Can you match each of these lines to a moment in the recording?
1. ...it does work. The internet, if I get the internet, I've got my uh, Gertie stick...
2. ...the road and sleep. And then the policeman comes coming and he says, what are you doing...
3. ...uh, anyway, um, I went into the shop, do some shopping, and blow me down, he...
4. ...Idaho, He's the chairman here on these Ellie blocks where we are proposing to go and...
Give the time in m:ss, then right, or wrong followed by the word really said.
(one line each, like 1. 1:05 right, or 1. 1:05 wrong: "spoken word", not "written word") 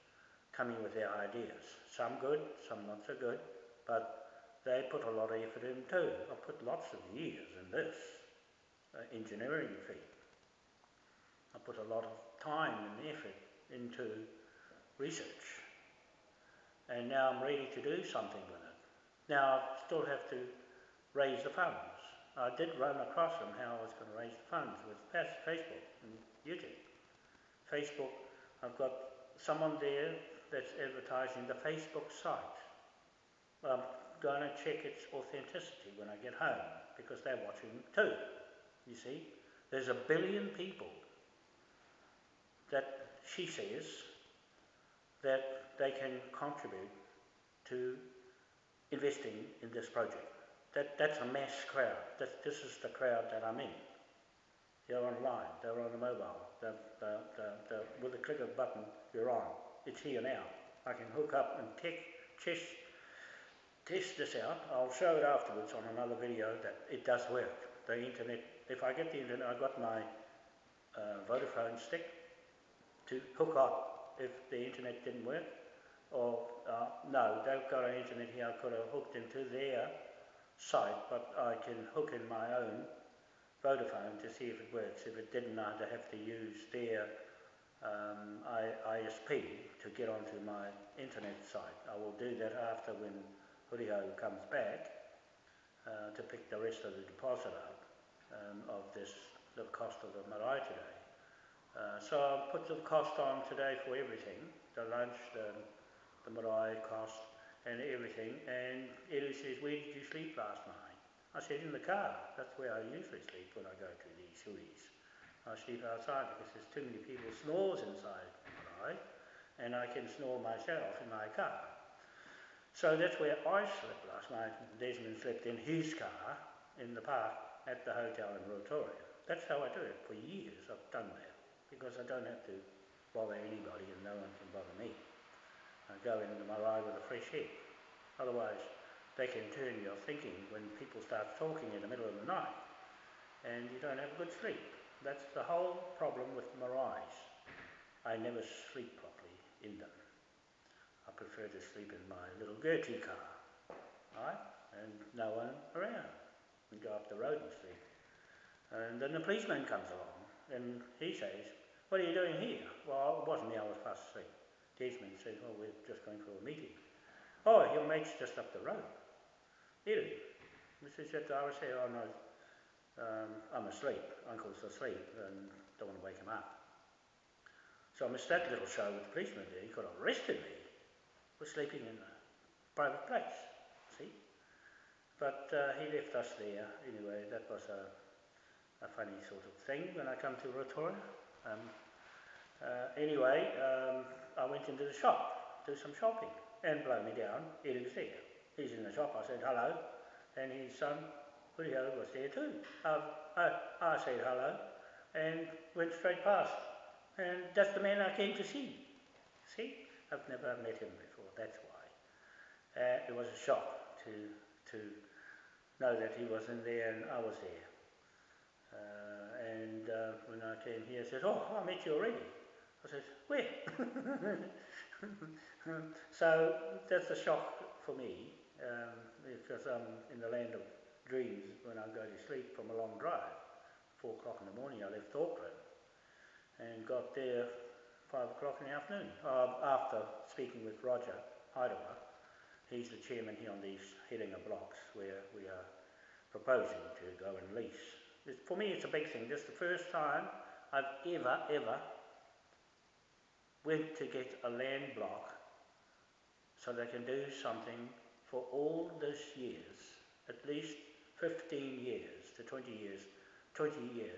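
1. 1:06 wrong: "Vodafone", not "Gertie"
2. 2:37 wrong: "along", not "coming"
3. 3:12 right
4. 4:01 wrong: "Herenga", not "Ellie".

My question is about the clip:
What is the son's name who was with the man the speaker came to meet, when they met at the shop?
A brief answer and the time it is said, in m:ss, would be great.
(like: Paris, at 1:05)
Woodhill, at 3:21.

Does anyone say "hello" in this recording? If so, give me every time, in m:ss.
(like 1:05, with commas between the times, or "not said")
3:19, 3:24.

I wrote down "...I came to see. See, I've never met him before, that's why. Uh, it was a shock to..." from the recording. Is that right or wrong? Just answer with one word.
right.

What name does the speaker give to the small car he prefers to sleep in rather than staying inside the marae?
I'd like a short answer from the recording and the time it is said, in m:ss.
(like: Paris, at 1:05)
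Gertie, at 2:32.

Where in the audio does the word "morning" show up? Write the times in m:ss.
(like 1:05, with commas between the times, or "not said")
3:54.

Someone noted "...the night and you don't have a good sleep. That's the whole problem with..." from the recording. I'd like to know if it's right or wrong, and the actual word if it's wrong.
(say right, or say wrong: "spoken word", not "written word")
right.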